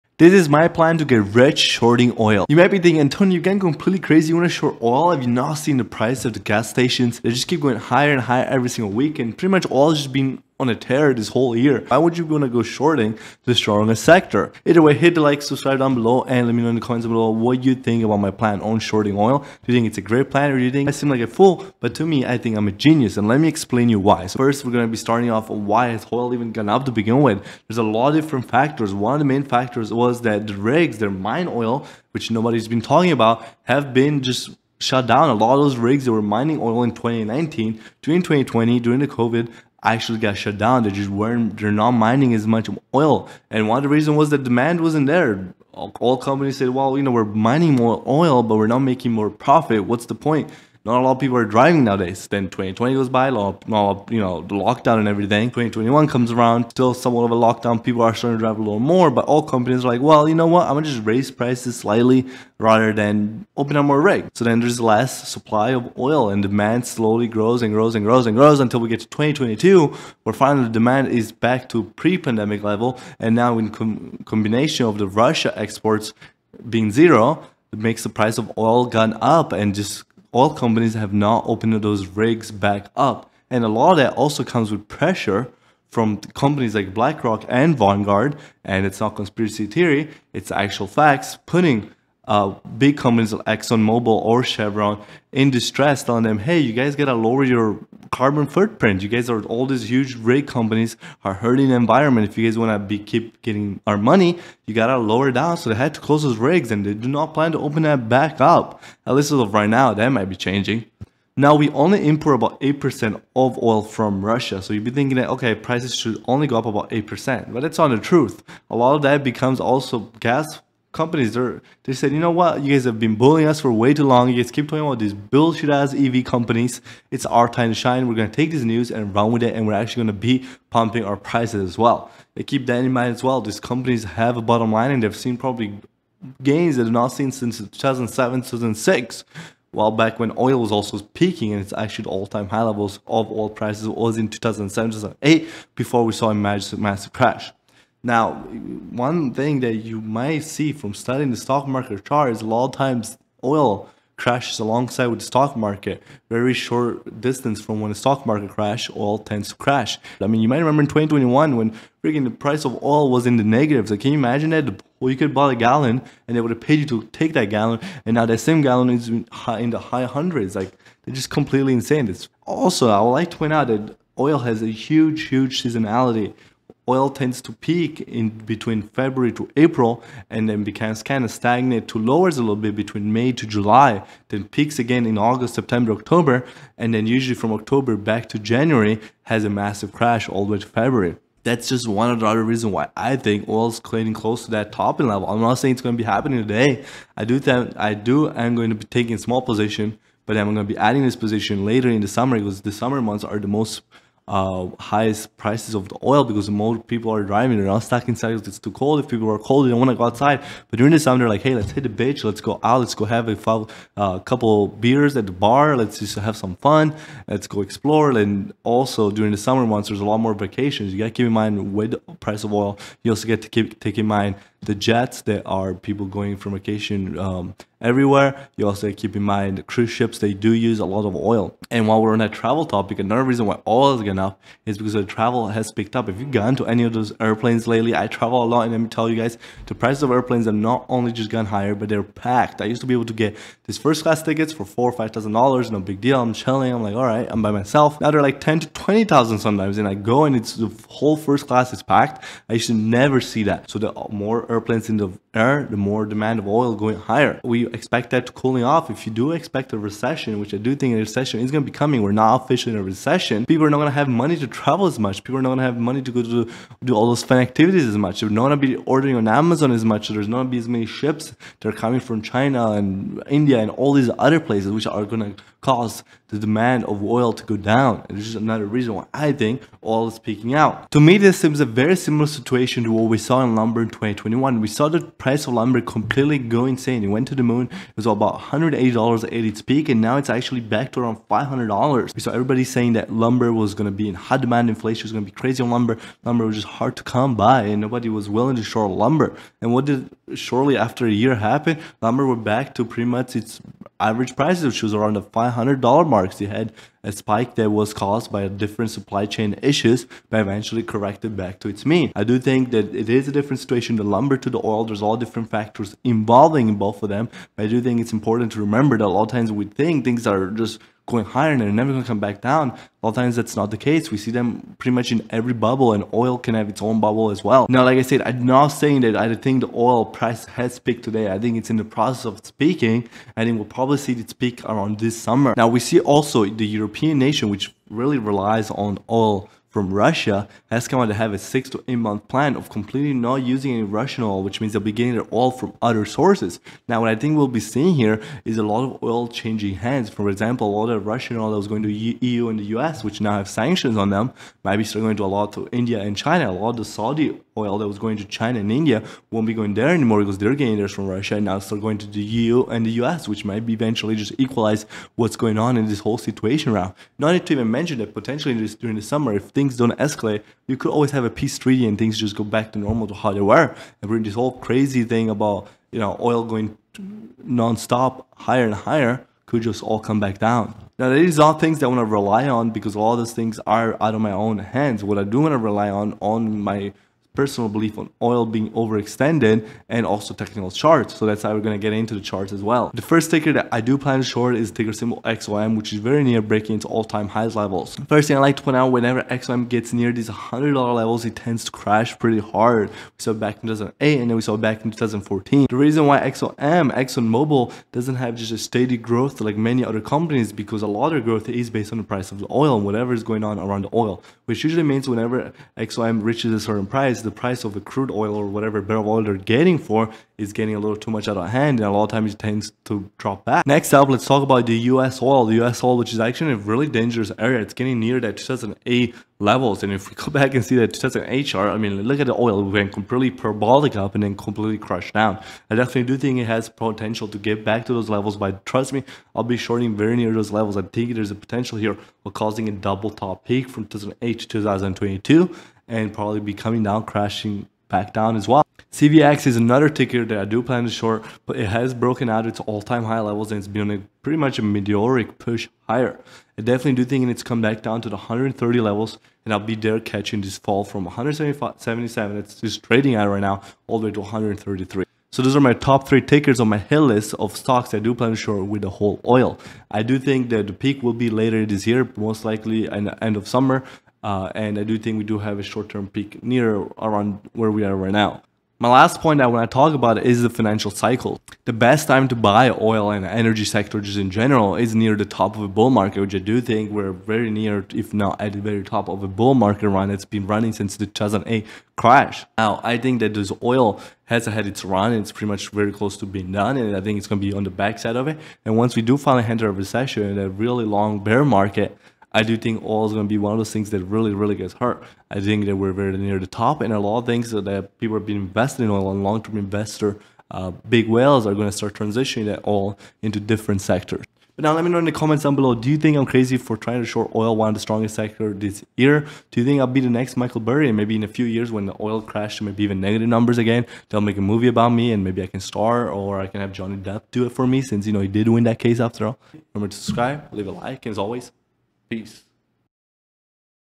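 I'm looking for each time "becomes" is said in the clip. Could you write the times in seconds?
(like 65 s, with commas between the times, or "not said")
119 s, 180 s.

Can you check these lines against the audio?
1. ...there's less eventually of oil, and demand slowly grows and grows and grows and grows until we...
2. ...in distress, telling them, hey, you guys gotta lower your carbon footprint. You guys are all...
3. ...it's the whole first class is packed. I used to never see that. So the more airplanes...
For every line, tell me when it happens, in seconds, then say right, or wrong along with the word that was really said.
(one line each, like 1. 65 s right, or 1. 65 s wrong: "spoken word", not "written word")
1. 64 s wrong: "supply", not "eventually"
2. 95 s right
3. 250 s right.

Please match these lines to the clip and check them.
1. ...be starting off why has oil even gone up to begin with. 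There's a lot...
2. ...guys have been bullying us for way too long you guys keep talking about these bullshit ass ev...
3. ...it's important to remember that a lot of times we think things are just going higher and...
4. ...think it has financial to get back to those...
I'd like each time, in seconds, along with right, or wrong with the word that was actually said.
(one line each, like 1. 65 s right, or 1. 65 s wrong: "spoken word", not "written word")
1. 24 s right
2. 122 s right
3. 318 s right
4. 436 s wrong: "potential", not "financial".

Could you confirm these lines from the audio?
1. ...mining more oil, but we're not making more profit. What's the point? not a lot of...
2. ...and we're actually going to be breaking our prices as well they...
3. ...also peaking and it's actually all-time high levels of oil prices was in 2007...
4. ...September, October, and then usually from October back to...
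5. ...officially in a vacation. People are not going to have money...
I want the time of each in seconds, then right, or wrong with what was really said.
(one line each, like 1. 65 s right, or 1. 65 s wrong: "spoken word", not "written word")
1. 47 s right
2. 129 s wrong: "pumping", not "breaking"
3. 140 s right
4. 185 s right
5. 262 s wrong: "recession", not "vacation".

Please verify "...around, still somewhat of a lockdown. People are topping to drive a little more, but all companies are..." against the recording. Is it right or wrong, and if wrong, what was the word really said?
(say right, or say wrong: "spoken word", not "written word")
wrong: "starting", not "topping".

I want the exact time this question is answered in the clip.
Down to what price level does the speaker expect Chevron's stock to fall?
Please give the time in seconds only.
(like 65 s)
464 s.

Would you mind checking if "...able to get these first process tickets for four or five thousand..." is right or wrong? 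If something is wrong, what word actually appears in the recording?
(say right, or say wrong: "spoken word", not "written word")
wrong: "class", not "process".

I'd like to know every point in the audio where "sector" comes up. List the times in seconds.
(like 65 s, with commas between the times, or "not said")
14 s, 483 s, 513 s, 518 s.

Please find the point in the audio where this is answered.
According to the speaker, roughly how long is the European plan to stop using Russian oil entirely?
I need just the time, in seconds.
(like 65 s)
341 s.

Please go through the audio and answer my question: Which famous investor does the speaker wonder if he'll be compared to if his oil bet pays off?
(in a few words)
Michael Burry.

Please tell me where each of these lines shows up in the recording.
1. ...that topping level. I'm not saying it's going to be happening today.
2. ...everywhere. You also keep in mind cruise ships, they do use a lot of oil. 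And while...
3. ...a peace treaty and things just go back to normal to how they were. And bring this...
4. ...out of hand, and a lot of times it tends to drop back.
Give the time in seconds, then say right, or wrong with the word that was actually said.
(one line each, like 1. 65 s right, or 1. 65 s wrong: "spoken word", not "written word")
1. 194 s right
2. 227 s right
3. 371 s right
4. 421 s right.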